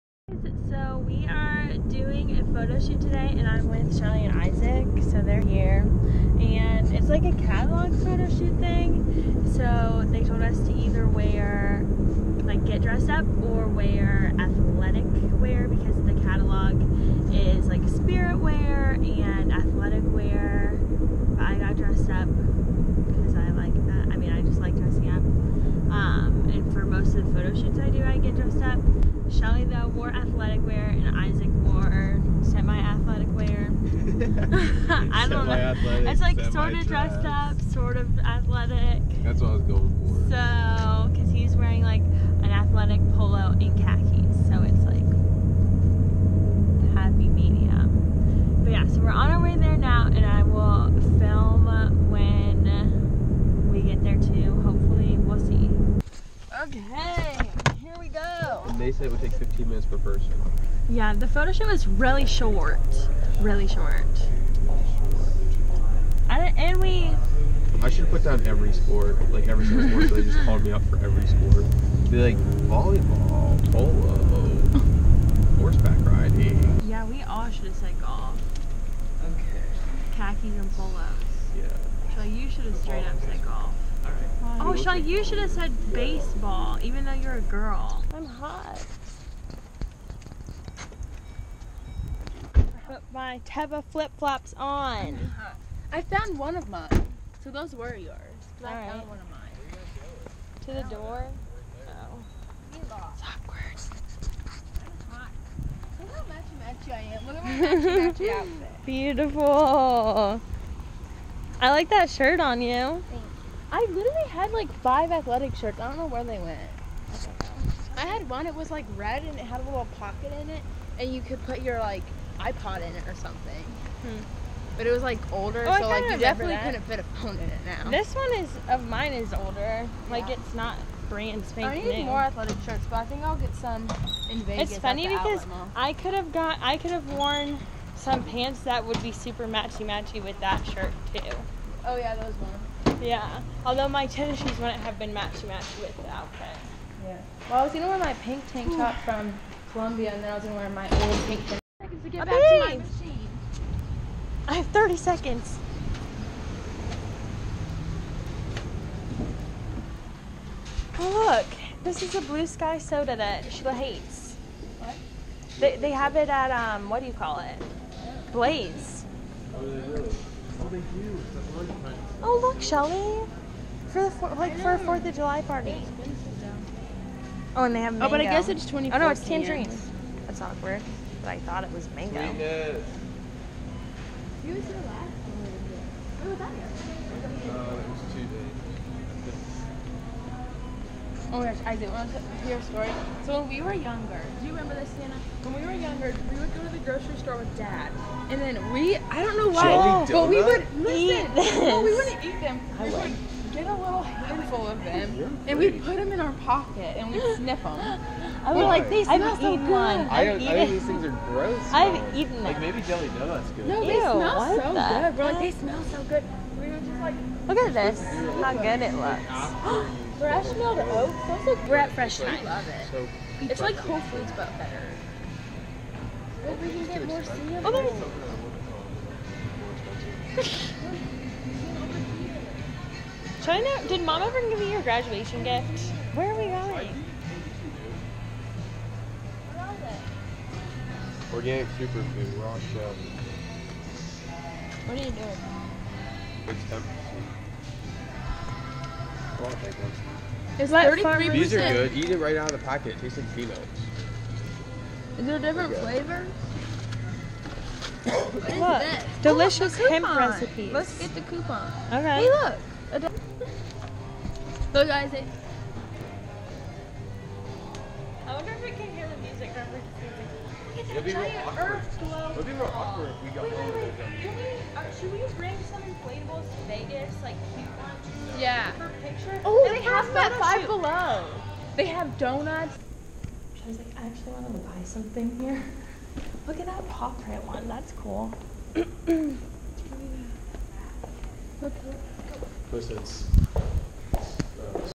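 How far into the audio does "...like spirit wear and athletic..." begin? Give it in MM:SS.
00:17.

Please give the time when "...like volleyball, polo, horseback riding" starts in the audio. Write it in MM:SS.
01:12.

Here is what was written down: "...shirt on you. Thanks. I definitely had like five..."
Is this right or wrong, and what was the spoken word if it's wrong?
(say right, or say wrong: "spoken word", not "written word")
wrong: "literally", not "definitely".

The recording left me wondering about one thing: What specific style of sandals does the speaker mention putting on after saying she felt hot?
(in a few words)
Teva flip flops.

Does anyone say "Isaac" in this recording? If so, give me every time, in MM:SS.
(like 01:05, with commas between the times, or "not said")
00:04, 00:31.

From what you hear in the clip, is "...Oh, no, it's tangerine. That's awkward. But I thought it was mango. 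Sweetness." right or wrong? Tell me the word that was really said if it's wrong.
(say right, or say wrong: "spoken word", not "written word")
right.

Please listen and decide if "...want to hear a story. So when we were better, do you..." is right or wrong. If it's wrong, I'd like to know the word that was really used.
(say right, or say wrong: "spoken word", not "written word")
wrong: "younger", not "better".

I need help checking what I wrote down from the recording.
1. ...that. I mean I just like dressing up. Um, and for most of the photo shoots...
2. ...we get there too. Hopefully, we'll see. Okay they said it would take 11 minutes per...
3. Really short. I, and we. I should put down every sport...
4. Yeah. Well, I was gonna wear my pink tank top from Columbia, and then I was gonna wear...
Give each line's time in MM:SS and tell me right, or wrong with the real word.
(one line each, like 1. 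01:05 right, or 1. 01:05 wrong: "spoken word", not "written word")
1. 00:23 right
2. 00:53 wrong: "15", not "11"
3. 01:03 right
4. 02:27 right.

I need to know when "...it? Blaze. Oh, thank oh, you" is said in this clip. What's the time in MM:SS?
02:47.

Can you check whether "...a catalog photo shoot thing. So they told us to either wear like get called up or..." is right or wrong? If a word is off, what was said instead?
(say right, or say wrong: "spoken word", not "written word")
wrong: "dressed", not "called".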